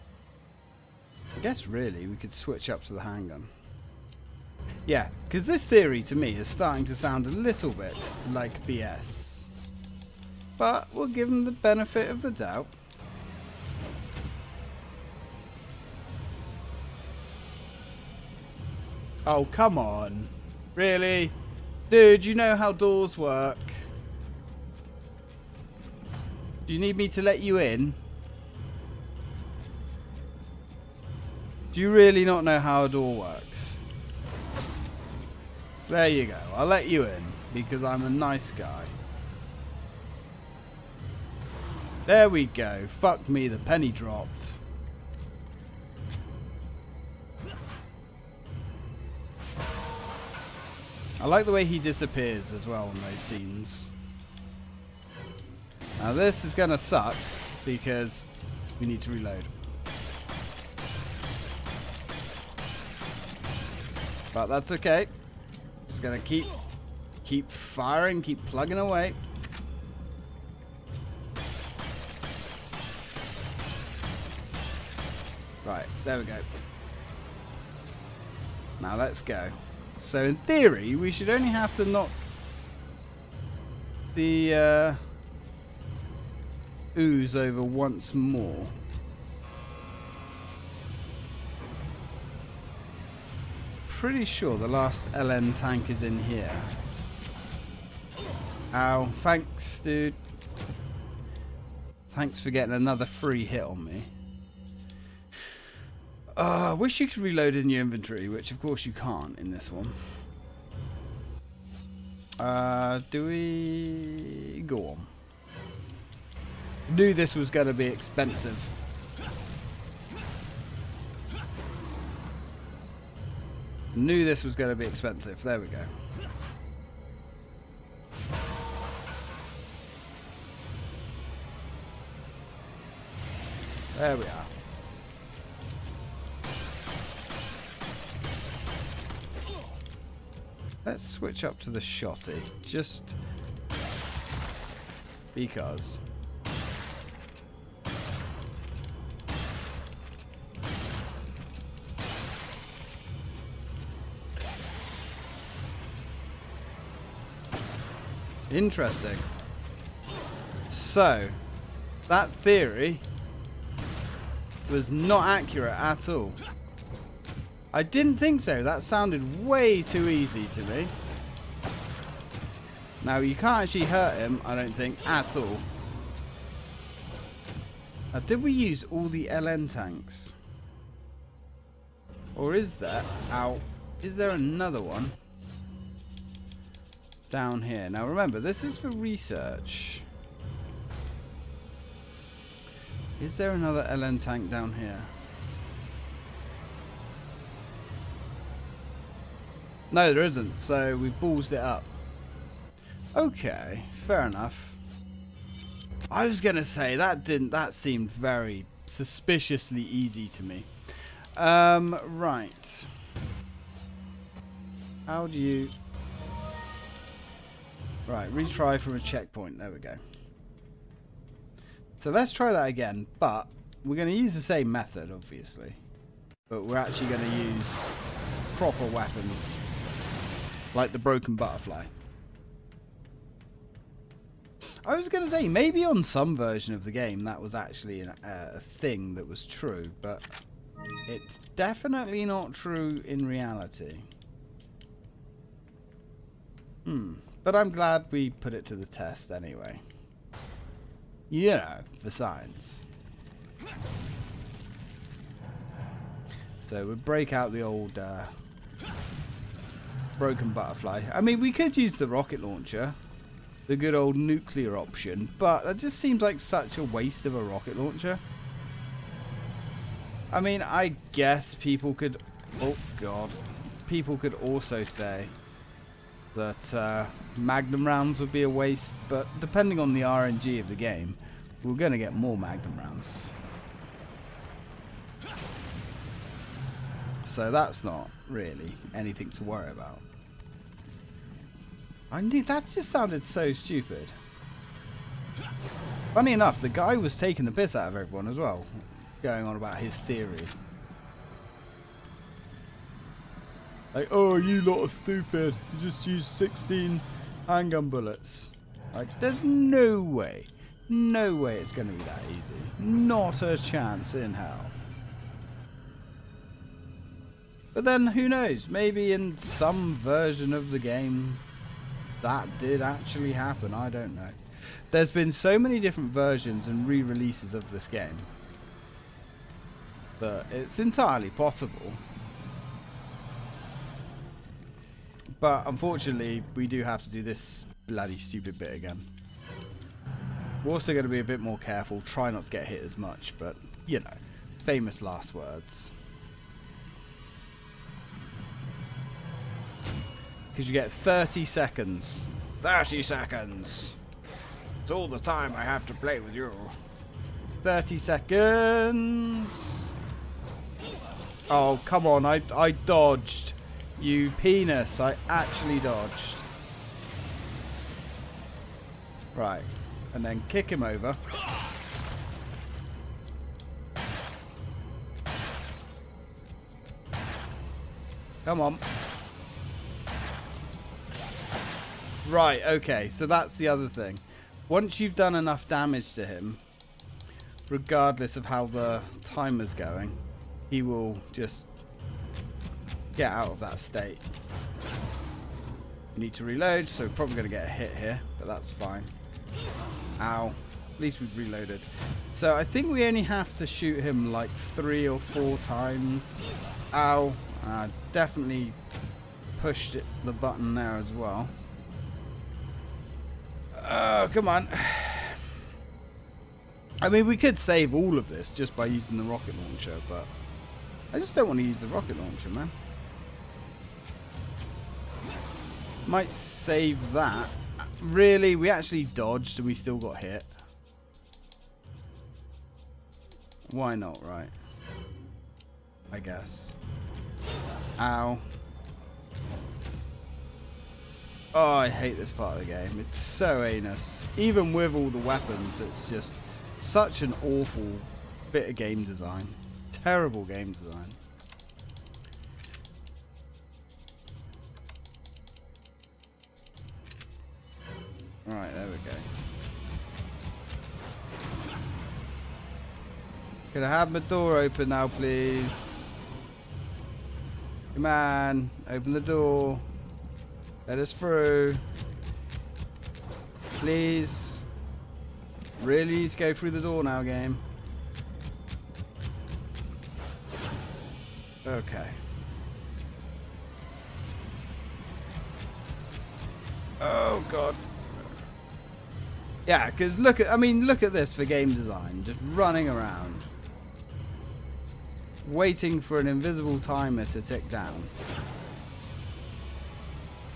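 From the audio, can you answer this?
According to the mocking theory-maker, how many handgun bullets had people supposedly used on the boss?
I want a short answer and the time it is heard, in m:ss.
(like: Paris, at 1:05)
16, at 5:06.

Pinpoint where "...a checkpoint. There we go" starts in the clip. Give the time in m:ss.
3:38.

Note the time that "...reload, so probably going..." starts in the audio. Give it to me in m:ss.
6:36.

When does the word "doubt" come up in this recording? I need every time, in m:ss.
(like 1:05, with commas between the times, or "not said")
0:12.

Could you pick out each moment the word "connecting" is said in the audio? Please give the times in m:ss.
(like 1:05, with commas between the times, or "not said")
not said.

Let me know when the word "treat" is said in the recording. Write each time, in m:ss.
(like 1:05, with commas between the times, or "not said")
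not said.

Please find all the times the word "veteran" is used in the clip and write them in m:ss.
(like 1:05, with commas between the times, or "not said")
not said.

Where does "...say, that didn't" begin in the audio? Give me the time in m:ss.
3:26.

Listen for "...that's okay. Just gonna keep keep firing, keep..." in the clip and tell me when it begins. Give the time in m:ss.
1:04.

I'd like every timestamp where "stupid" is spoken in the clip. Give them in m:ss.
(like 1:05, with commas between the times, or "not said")
4:53, 5:04, 5:38.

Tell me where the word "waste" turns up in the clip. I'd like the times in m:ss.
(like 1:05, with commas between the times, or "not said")
4:26, 4:38.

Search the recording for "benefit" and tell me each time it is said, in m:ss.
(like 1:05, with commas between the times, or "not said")
0:11.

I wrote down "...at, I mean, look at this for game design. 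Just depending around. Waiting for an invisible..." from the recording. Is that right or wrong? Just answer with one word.
wrong.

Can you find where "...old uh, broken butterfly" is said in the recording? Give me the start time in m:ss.
4:17.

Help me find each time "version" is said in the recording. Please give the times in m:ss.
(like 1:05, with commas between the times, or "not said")
3:56, 5:19, 5:26.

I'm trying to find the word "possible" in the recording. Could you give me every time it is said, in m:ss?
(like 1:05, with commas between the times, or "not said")
5:31.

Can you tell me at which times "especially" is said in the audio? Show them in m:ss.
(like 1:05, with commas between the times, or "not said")
not said.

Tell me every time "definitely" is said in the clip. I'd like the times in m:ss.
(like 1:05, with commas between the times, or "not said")
4:01, 6:48.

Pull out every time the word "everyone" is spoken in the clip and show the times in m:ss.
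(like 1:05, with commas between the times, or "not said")
4:57.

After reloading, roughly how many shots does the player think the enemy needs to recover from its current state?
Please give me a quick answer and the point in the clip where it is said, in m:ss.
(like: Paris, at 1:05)
three or four, at 6:44.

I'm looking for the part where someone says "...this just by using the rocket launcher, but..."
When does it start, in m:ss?
6:58.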